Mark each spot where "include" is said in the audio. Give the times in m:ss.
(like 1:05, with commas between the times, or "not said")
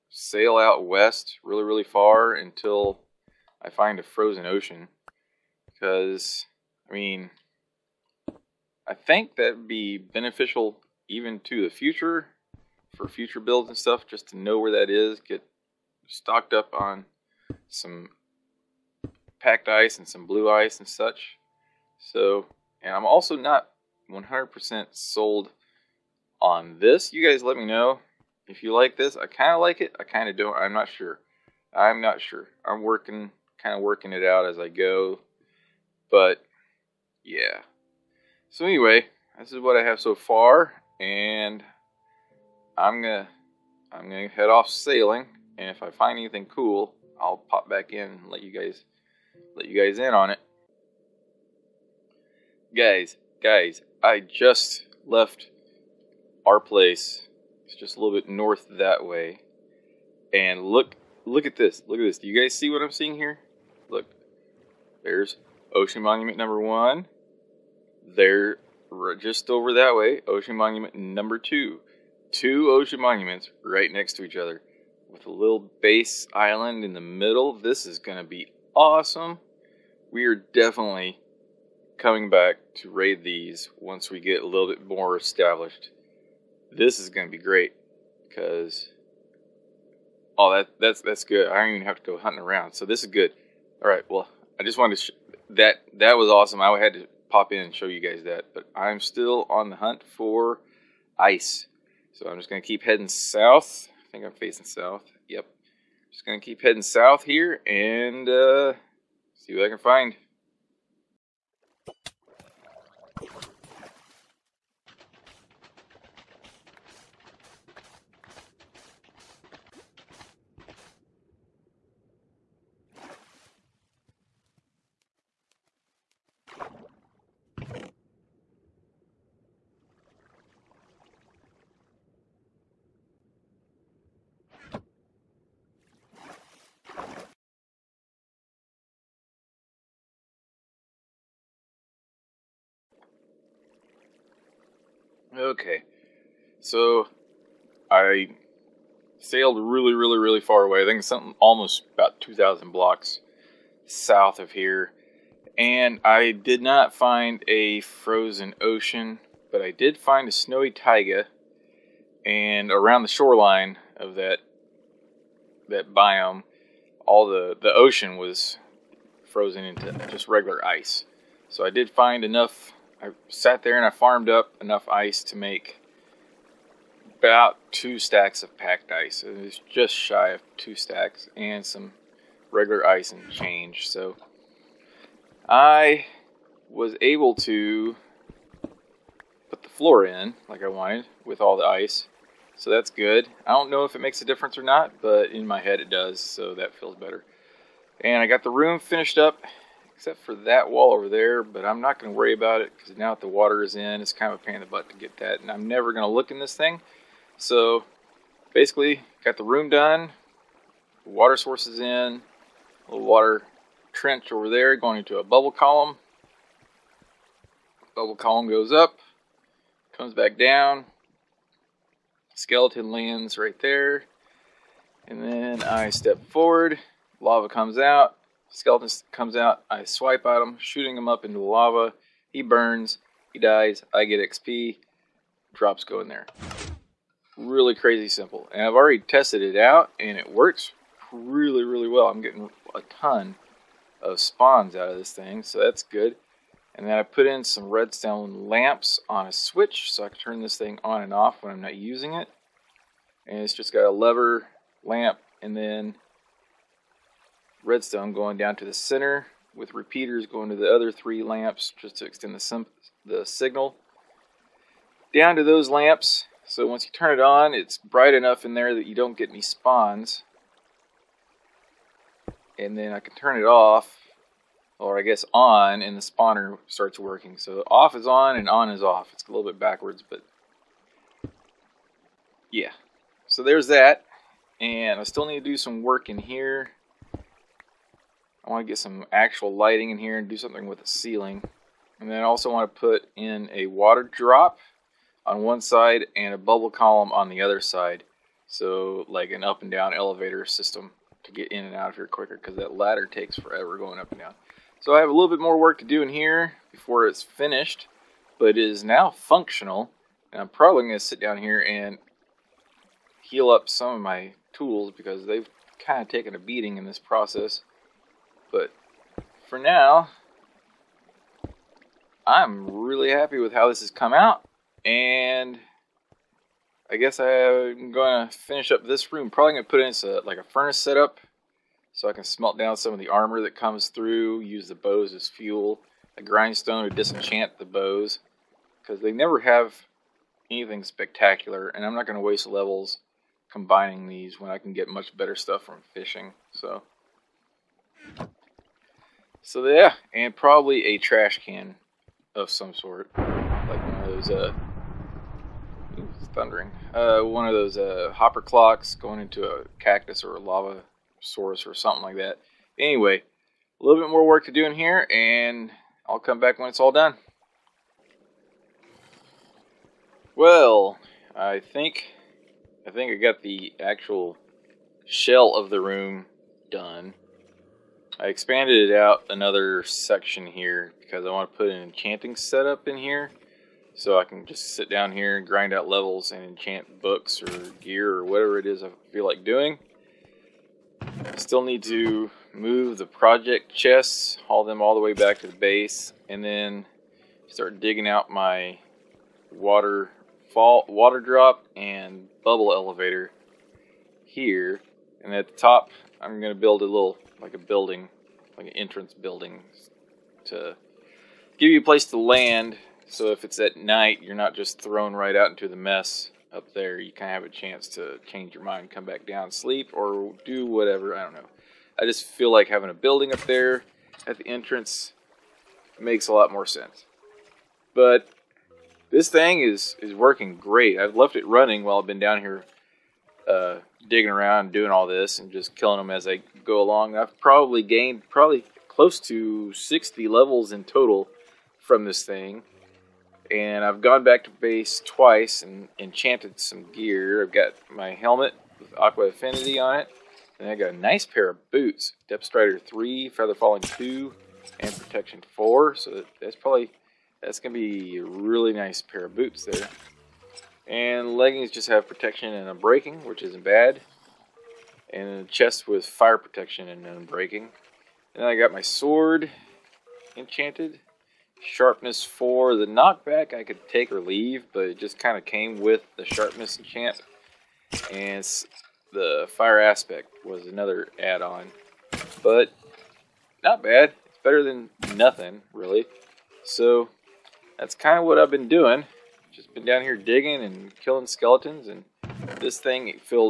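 not said.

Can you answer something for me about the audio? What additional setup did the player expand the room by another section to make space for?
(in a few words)
Enchanting setup.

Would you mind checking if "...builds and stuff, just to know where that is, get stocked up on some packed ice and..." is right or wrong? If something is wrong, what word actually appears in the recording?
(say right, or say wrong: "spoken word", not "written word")
right.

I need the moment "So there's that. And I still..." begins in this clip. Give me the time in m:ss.
4:43.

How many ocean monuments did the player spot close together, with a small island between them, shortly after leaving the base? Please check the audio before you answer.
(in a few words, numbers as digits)
2.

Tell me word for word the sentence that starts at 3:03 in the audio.
So I was able to put the floor in like I wanted with all the ice.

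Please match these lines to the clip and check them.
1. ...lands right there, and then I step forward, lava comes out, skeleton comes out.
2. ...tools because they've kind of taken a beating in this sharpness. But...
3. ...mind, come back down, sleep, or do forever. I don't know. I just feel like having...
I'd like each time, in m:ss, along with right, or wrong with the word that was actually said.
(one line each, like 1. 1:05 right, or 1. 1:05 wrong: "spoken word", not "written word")
1. 3:42 right
2. 5:14 wrong: "process", not "sharpness"
3. 6:58 wrong: "whatever", not "forever".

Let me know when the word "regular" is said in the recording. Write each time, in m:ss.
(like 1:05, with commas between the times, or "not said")
2:50, 3:02.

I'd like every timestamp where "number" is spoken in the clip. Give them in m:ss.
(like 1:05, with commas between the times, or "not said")
1:06, 1:10.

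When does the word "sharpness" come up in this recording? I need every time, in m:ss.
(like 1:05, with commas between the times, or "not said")
7:51, 7:56.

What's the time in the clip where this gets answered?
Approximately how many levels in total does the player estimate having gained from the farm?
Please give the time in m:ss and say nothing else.
7:19.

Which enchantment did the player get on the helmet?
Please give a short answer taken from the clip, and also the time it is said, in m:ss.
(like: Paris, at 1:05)
Aqua Affinity, at 7:28.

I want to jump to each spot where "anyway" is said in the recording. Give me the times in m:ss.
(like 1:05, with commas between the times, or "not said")
0:38, 6:02.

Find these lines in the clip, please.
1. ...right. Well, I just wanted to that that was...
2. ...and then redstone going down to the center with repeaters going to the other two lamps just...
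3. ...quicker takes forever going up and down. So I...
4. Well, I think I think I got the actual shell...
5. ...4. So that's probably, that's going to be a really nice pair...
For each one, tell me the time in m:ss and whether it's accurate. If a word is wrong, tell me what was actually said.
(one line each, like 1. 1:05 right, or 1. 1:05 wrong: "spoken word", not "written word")
1. 1:33 right
2. 4:15 wrong: "three", not "two"
3. 5:02 wrong: "ladder", not "quicker"
4. 6:10 right
5. 7:35 right.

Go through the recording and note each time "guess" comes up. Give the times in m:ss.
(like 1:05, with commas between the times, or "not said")
4:35, 5:26.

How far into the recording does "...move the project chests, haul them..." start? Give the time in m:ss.
6:32.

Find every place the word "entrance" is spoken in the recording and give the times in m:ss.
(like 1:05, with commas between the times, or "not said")
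6:48, 7:04.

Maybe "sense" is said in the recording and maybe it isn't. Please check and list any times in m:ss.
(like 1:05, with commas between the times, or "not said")
7:06.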